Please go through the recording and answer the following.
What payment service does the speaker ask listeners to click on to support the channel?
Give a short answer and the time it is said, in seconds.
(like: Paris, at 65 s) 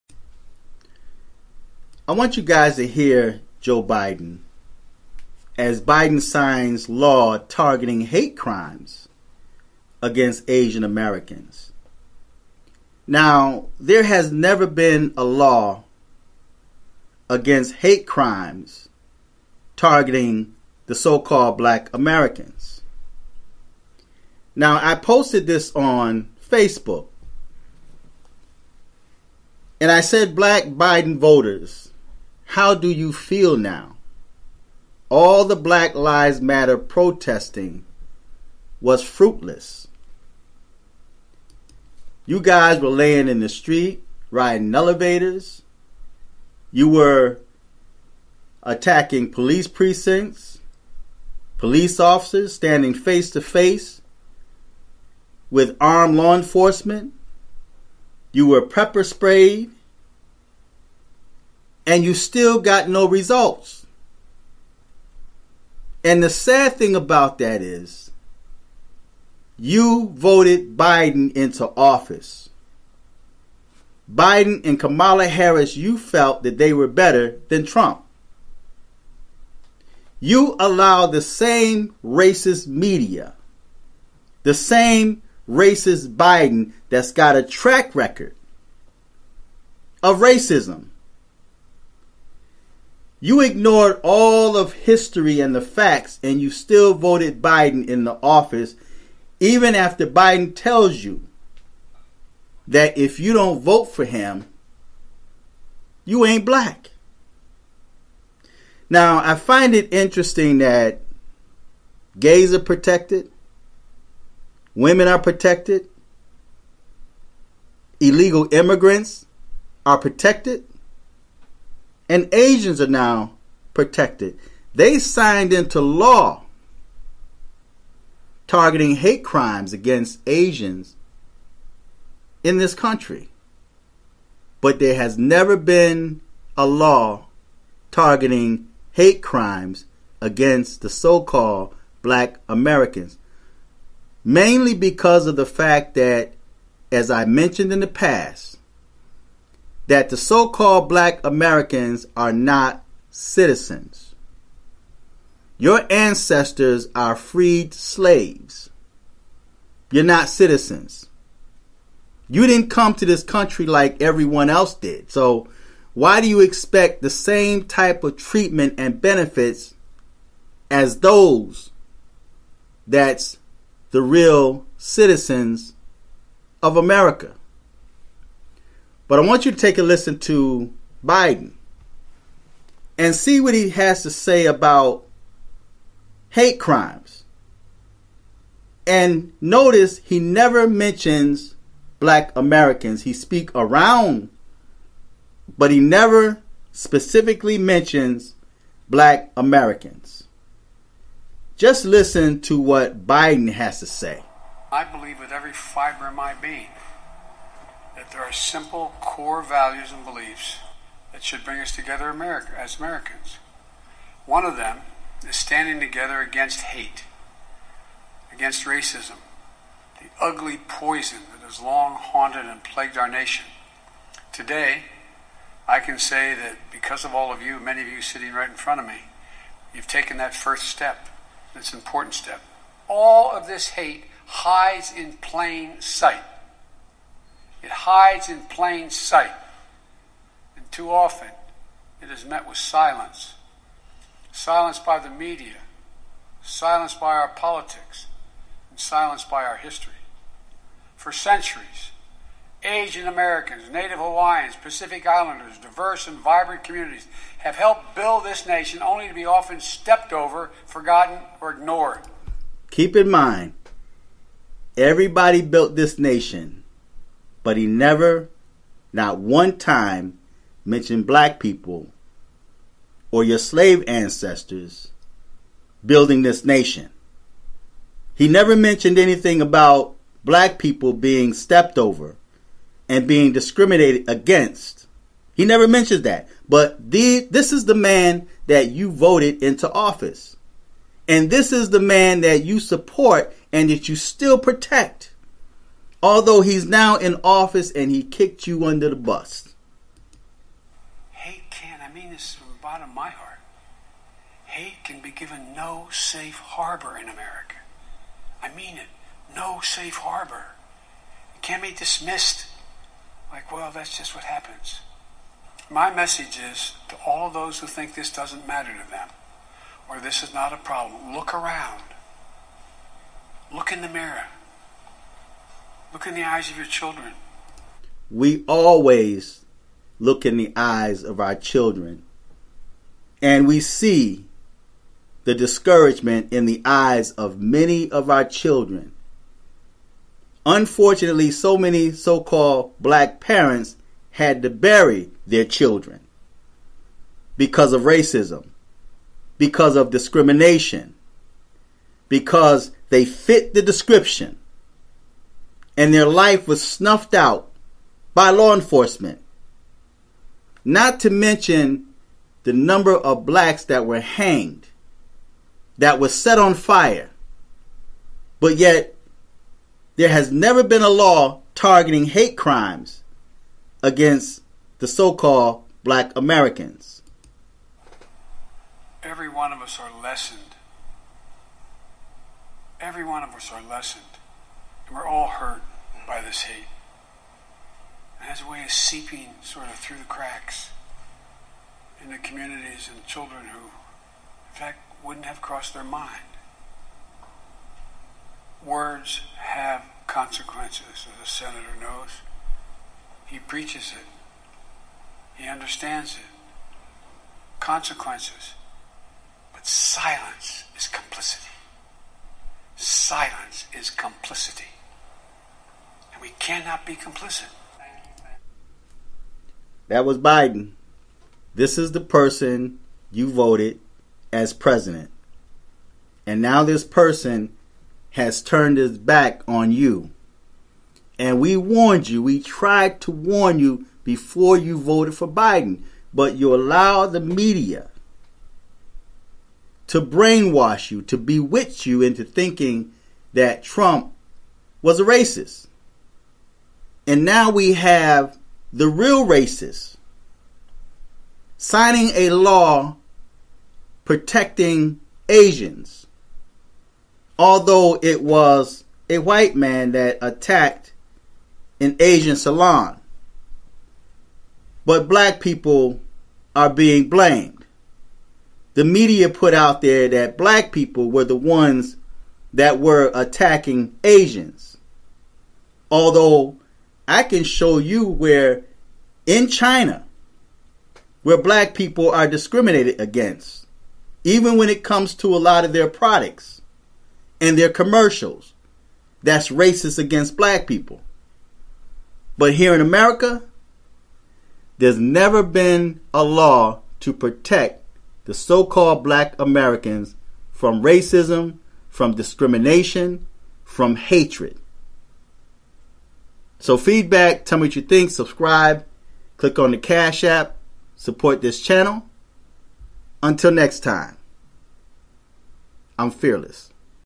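Cash App, at 509 s.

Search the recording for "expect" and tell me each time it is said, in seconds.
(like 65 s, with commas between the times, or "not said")
166 s.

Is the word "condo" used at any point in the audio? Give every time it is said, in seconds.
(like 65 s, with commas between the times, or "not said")
not said.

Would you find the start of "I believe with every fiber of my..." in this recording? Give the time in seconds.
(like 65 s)
204 s.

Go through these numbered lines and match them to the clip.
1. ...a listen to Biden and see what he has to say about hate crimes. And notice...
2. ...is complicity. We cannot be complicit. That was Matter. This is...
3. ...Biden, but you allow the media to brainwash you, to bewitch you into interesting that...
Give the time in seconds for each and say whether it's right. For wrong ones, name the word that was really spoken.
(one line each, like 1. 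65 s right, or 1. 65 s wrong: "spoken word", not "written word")
1. 179 s right
2. 413 s wrong: "Biden", not "Matter"
3. 435 s wrong: "thinking", not "interesting".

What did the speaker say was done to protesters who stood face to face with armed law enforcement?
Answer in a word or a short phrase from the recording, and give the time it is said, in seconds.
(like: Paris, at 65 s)
pepper sprayed, at 58 s.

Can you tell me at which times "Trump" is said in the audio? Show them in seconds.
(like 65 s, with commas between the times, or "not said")
77 s, 443 s.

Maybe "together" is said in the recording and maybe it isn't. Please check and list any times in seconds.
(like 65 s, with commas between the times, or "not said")
211 s, 215 s.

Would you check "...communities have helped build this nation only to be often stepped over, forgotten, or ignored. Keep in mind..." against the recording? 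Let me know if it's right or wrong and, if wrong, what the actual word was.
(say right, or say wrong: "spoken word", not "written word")
right.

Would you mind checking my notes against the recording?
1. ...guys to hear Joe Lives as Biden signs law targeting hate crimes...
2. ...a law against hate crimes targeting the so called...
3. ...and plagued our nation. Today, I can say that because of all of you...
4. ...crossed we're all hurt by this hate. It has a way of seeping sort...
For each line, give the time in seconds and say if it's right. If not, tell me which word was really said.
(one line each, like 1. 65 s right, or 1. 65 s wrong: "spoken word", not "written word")
1. 2 s wrong: "Biden", not "Lives"
2. 15 s right
3. 222 s right
4. 383 s wrong: "lessened", not "crossed".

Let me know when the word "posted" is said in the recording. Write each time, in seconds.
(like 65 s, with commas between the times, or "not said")
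24 s.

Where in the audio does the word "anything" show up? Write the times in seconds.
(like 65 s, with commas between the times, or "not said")
278 s.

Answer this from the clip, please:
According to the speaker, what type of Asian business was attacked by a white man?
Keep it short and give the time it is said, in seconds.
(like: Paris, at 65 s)
salon, at 462 s.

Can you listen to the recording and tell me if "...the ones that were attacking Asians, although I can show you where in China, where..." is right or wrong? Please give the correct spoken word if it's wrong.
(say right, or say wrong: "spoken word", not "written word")
right.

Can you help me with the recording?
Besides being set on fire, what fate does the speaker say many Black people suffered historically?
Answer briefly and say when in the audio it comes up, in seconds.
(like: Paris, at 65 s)
hanged, at 364 s.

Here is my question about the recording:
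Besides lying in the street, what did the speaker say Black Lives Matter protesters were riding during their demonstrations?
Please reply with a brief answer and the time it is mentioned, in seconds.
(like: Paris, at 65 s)
elevators, at 44 s.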